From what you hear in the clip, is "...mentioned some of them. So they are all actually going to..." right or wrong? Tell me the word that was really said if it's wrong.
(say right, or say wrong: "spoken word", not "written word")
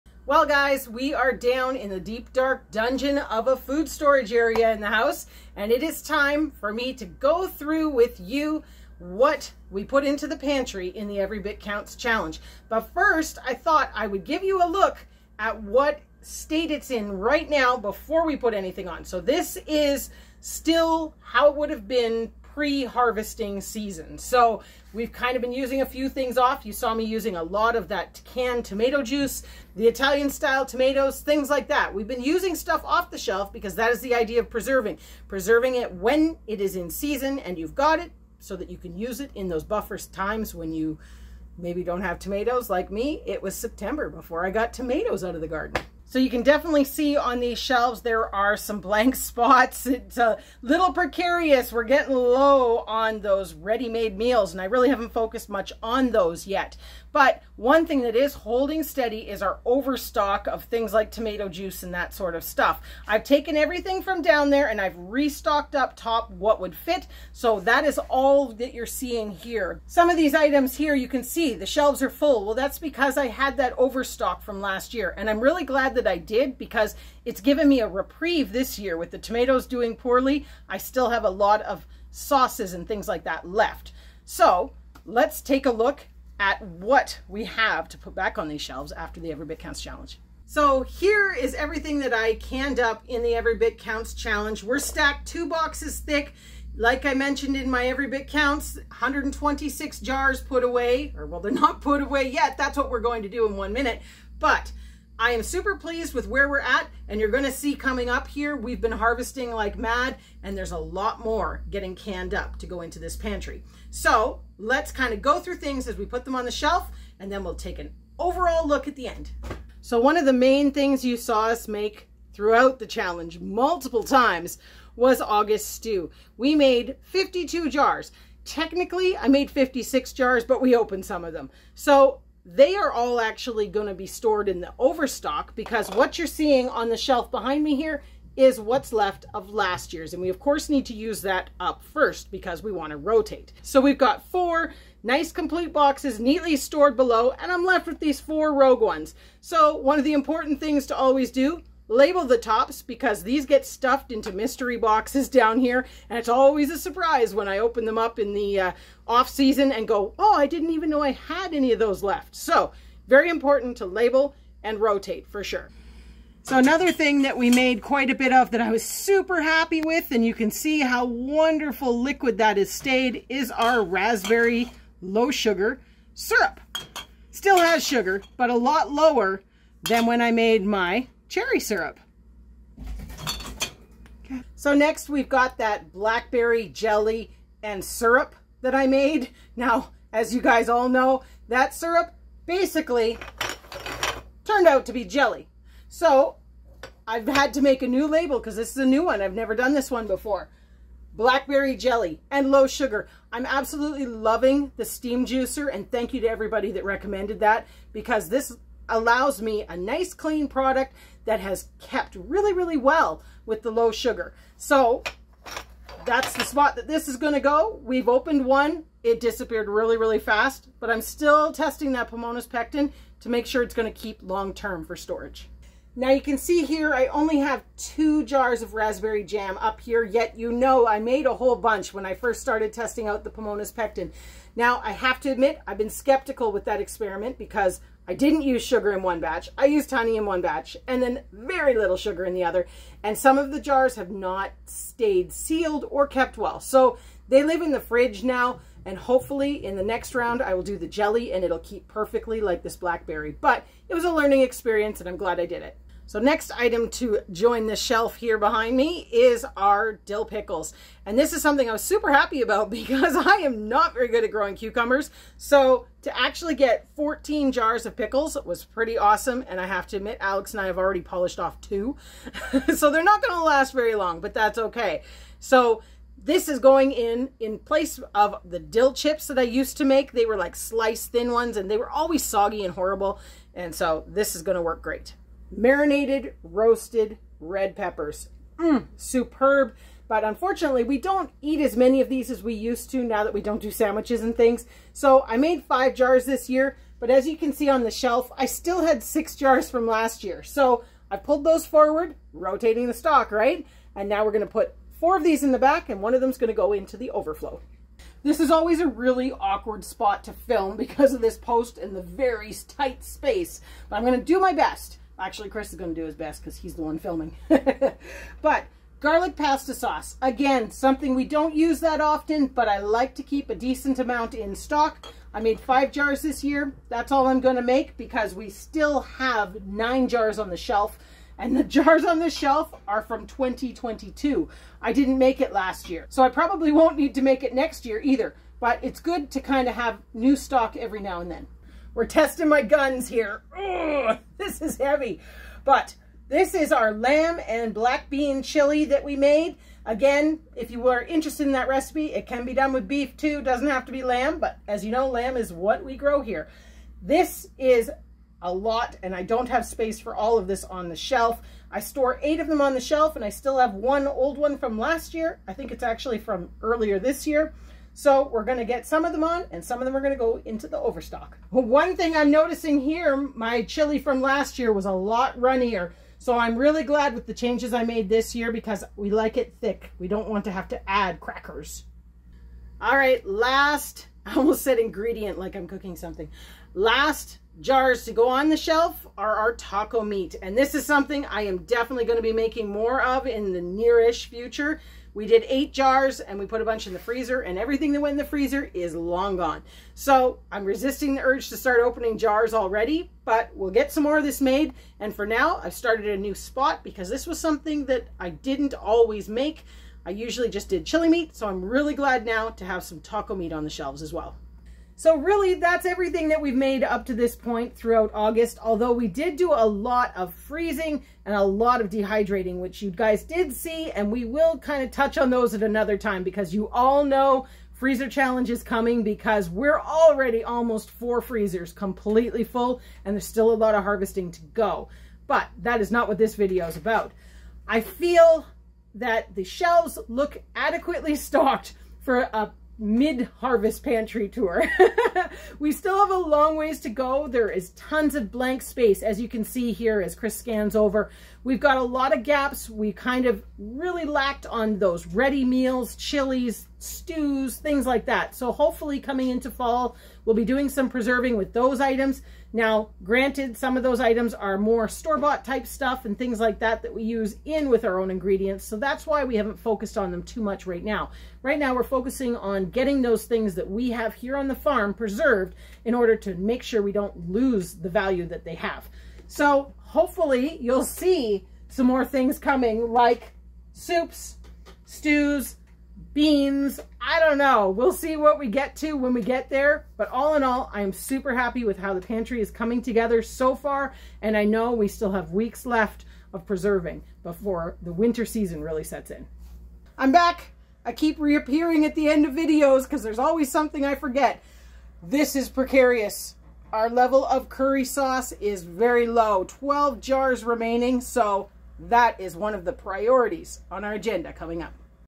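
wrong: "opened", not "mentioned".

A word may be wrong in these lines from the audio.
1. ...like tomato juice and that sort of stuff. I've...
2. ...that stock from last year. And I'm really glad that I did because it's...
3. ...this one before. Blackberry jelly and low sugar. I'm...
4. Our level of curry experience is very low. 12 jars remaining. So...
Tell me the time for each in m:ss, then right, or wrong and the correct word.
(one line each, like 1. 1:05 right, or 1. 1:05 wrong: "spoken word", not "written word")
1. 1:00 right
2. 1:13 wrong: "overstock", not "stock"
3. 3:19 right
4. 8:26 wrong: "sauce", not "experience".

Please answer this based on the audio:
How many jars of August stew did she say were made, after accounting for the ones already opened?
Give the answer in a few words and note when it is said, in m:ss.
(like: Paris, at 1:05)
52, at 2:07.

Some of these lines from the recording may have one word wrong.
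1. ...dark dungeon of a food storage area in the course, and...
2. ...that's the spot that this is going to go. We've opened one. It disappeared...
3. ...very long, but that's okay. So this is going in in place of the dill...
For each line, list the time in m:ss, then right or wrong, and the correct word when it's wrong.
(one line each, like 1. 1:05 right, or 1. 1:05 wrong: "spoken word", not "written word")
1. 0:02 wrong: "house", not "course"
2. 3:36 right
3. 4:33 right.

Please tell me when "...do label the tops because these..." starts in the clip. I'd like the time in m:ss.
2:31.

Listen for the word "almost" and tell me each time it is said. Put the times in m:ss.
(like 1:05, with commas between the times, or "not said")
6:24, 7:10.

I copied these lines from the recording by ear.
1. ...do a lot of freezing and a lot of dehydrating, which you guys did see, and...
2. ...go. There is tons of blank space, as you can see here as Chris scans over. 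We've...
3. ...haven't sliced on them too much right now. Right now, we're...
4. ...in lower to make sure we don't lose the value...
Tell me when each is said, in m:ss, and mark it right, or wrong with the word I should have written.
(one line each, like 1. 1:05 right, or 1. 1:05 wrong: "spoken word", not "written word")
1. 6:59 right
2. 7:26 right
3. 7:49 wrong: "focused", not "sliced"
4. 7:55 wrong: "order", not "lower".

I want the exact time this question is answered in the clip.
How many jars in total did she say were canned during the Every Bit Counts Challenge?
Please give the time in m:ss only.
1:38.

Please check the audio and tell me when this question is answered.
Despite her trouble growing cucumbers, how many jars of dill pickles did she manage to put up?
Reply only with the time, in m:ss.
4:26.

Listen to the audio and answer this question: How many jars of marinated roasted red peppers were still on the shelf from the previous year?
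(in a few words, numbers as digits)
6.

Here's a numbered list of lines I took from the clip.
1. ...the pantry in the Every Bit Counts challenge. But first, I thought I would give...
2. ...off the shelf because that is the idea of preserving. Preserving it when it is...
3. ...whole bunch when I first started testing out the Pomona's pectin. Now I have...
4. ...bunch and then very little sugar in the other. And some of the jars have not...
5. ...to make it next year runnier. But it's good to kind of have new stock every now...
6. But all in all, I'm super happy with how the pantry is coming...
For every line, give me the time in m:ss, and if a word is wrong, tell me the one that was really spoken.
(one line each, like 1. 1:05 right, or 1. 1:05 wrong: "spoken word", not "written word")
1. 0:10 right
2. 0:32 right
3. 3:51 right
4. 4:00 wrong: "batch", not "bunch"
5. 5:37 wrong: "either", not "runnier"
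6. 8:09 right.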